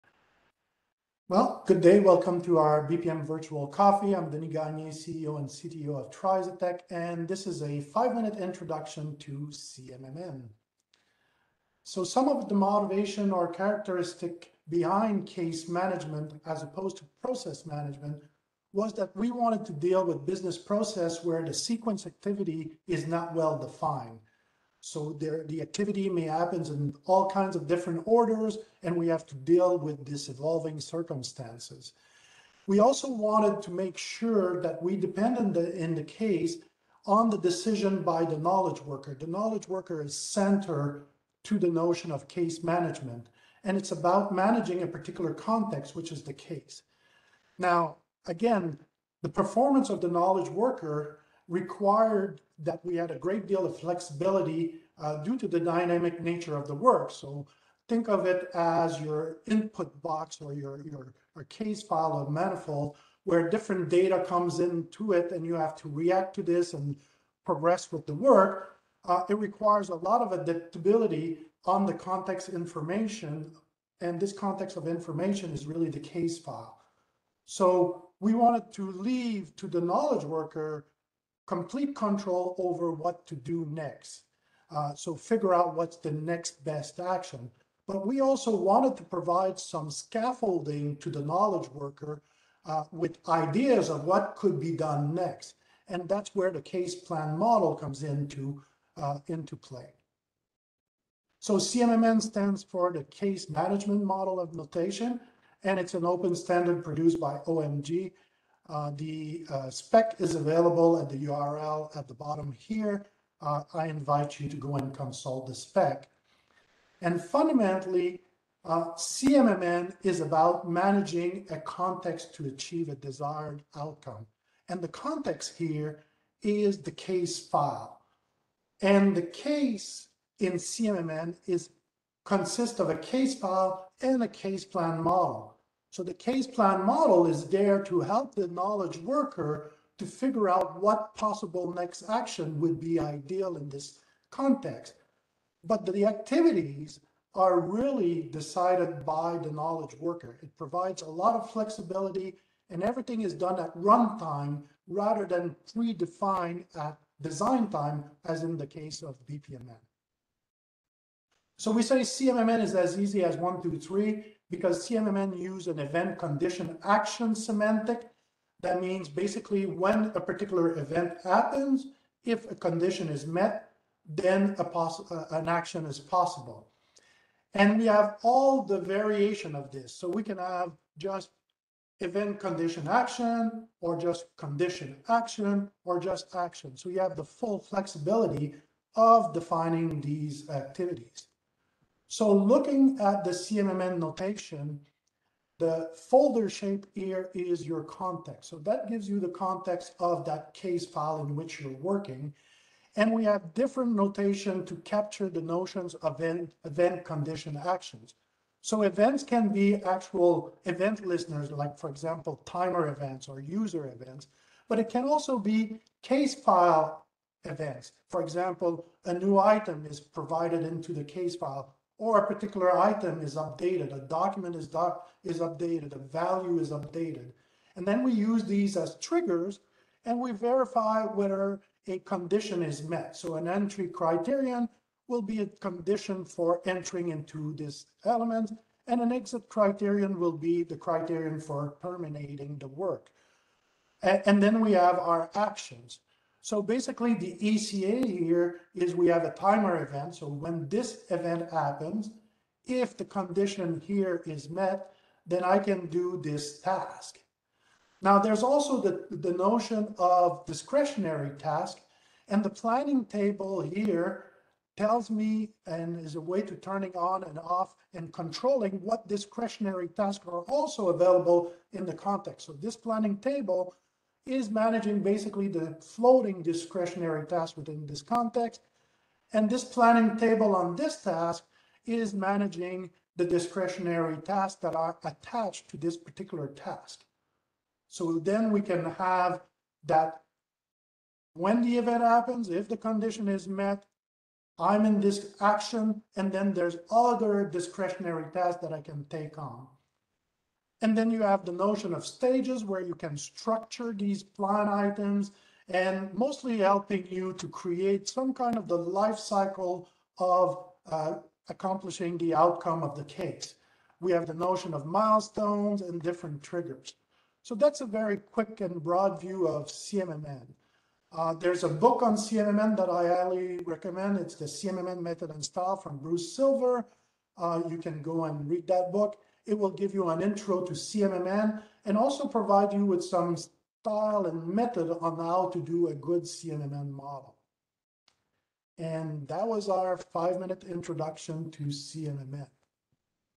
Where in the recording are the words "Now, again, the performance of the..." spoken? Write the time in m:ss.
0:47.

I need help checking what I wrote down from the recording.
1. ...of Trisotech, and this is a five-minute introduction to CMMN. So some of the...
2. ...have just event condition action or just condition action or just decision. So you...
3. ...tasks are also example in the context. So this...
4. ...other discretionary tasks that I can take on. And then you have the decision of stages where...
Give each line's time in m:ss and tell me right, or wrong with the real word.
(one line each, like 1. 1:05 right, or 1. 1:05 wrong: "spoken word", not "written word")
1. 0:05 right
2. 3:00 wrong: "action", not "decision"
3. 4:29 wrong: "available", not "example"
4. 4:56 wrong: "notion", not "decision".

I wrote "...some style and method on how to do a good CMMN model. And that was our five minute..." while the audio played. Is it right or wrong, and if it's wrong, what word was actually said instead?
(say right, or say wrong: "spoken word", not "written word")
right.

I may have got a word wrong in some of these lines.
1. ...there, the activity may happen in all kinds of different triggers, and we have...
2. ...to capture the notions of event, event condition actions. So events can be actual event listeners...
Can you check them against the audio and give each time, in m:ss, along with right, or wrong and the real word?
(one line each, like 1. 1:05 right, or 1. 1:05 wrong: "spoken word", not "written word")
1. 0:25 wrong: "orders", not "triggers"
2. 3:24 right.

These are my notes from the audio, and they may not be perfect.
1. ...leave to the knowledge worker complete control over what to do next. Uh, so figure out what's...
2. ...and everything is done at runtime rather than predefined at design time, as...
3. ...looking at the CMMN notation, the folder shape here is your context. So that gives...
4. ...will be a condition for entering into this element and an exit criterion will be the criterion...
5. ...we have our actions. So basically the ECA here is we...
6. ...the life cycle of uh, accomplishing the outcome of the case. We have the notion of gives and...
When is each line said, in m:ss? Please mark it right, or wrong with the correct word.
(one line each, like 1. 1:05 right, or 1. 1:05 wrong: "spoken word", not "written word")
1. 1:18 right
2. 2:32 right
3. 3:12 right
4. 3:55 right
5. 4:04 right
6. 5:08 wrong: "milestones", not "gives".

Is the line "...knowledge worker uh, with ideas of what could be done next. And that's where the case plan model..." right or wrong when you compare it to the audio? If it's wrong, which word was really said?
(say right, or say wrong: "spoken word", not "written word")
right.